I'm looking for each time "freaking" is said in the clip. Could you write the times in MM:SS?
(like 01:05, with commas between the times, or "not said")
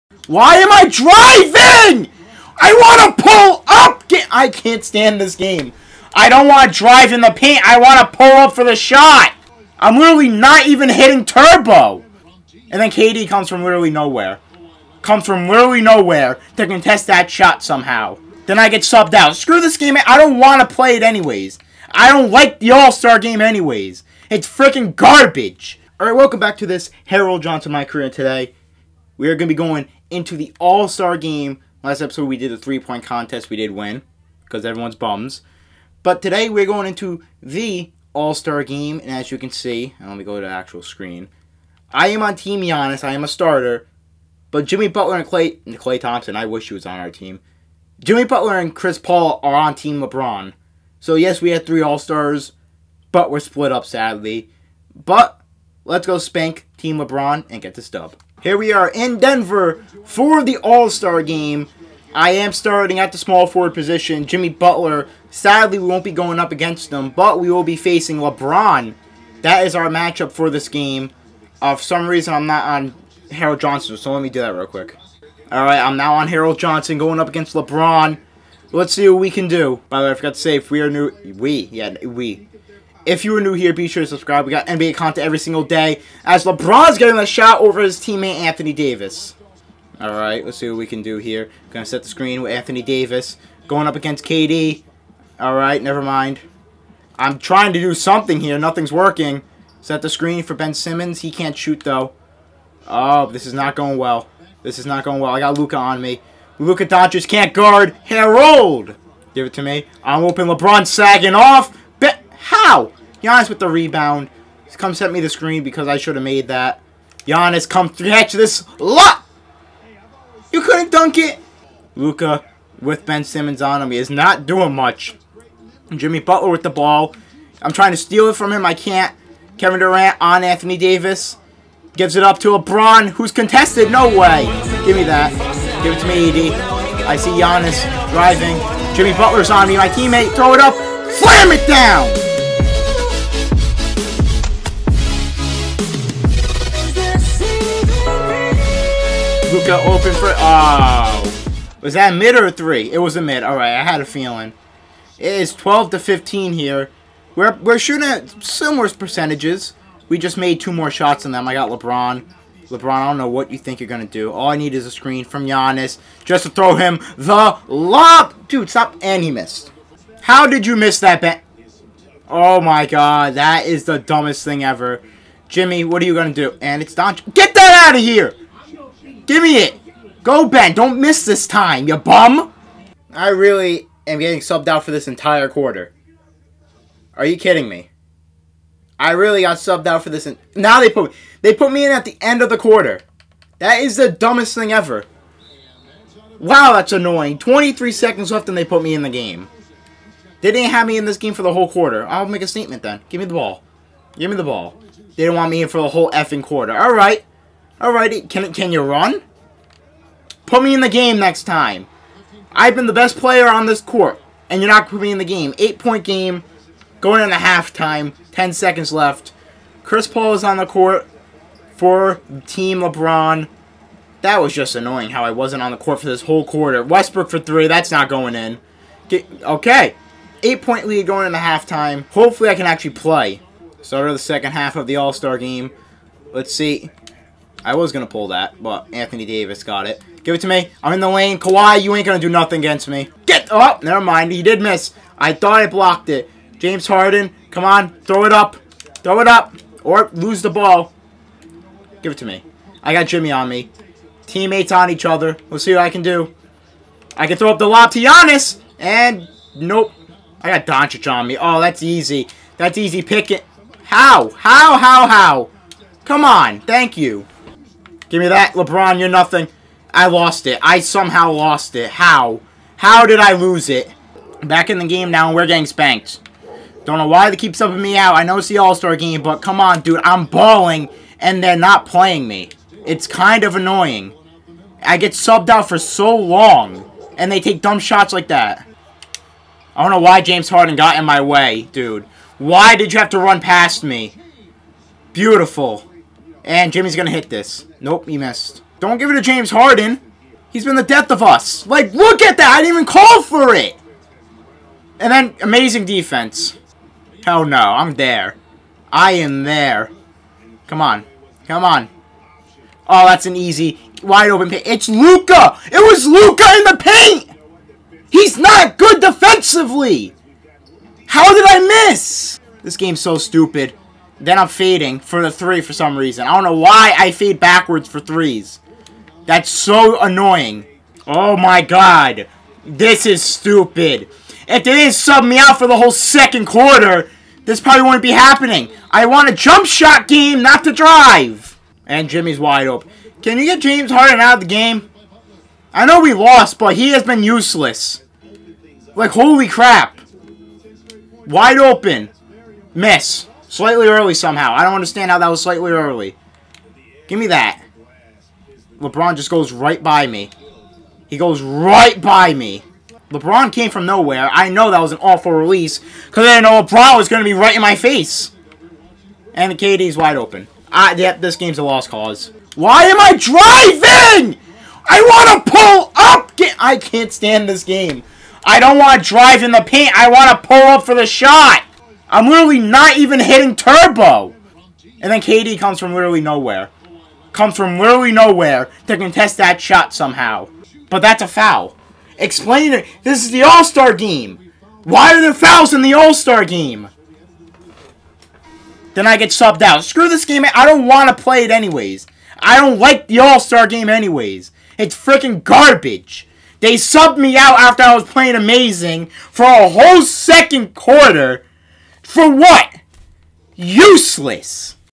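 00:24, 06:44.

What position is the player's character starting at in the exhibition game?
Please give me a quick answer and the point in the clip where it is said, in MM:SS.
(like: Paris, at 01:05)
Small forward, at 01:03.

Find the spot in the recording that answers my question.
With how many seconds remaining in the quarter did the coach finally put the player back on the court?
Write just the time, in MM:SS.
03:17.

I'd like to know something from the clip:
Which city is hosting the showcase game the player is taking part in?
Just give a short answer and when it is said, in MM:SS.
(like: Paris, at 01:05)
Denver, at 00:59.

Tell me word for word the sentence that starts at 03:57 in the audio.
I was going to pull that, but Anthony Davis got it.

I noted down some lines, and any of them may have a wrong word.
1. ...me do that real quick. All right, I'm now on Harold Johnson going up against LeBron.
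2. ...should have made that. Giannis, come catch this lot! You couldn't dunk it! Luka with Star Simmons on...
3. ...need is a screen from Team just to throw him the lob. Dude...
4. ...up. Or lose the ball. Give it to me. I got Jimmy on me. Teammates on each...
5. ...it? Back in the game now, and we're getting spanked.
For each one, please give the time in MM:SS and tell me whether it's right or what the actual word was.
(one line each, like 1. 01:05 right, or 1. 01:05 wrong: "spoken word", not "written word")
1. 01:14 right
2. 01:55 wrong: "Ben", not "Star"
3. 02:44 wrong: "Giannis", not "Team"
4. 04:09 right
5. 04:33 right.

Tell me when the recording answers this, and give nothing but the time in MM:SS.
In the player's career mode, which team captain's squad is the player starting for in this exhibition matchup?
00:42.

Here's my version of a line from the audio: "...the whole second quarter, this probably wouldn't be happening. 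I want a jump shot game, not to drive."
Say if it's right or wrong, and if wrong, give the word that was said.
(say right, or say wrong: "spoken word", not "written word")
right.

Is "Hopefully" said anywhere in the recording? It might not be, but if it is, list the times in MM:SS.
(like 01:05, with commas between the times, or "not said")
03:52.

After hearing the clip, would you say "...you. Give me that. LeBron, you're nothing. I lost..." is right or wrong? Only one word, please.
right.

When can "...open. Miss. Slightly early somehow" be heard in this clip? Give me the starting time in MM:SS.
05:51.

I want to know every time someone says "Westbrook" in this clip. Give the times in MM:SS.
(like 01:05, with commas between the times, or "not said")
03:46.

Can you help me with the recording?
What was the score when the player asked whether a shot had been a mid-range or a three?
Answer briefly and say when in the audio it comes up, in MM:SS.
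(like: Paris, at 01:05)
12 to 15, at 02:35.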